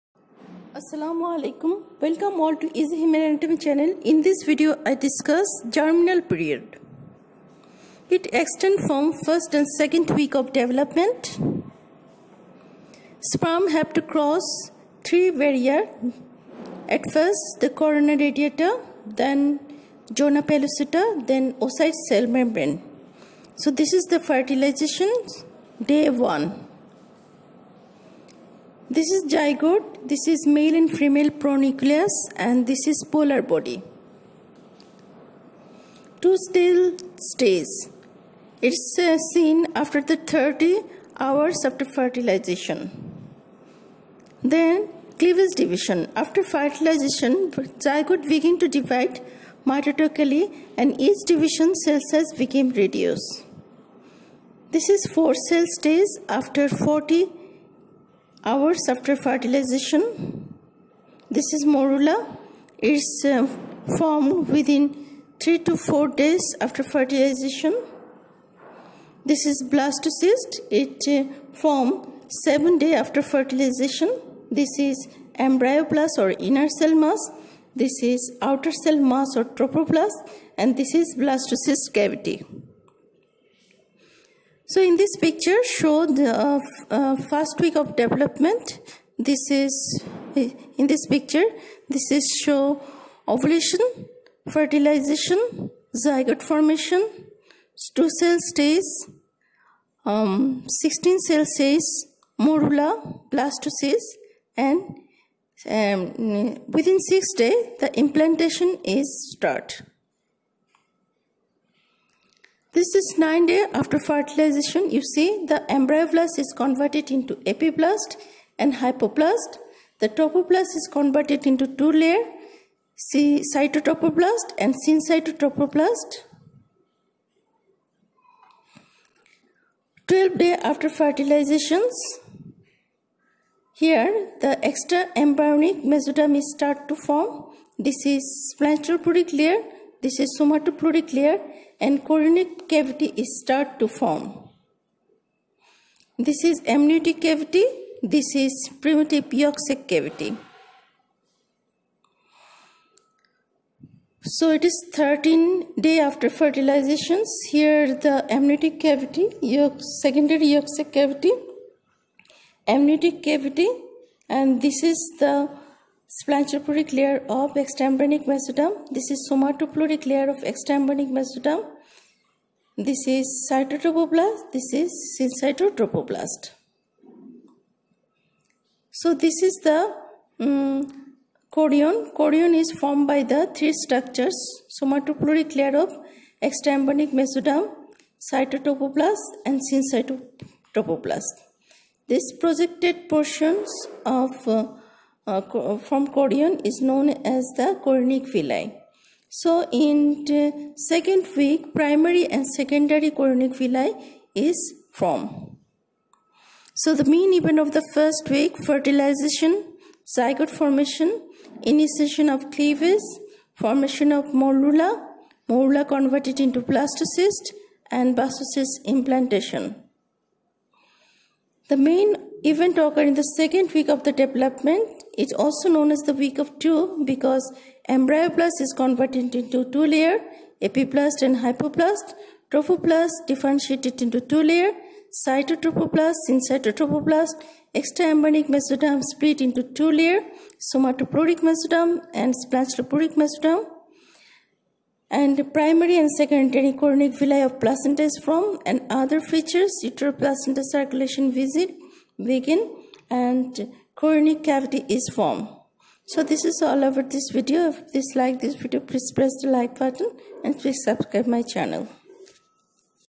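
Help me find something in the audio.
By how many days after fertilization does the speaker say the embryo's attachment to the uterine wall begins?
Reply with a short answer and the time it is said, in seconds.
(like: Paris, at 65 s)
6 days, at 106 s.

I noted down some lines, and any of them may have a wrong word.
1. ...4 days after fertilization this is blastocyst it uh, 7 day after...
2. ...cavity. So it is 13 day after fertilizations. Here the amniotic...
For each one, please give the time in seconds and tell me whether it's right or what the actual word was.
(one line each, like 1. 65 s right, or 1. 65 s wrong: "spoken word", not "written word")
1. 65 s right
2. 149 s right.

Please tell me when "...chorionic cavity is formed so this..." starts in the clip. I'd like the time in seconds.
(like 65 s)
254 s.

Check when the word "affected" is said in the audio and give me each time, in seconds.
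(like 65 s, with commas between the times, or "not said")
not said.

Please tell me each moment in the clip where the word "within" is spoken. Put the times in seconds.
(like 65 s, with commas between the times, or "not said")
64 s, 106 s.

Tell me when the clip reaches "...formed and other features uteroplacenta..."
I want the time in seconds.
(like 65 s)
248 s.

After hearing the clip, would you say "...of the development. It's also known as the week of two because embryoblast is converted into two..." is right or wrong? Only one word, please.
right.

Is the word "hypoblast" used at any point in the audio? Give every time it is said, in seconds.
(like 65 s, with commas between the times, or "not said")
118 s, 231 s.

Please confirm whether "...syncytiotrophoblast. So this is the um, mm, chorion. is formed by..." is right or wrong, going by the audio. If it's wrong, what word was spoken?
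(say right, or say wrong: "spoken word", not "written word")
right.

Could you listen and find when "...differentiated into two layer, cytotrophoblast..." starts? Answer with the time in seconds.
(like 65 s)
233 s.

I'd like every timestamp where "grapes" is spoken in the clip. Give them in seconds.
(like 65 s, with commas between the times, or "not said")
not said.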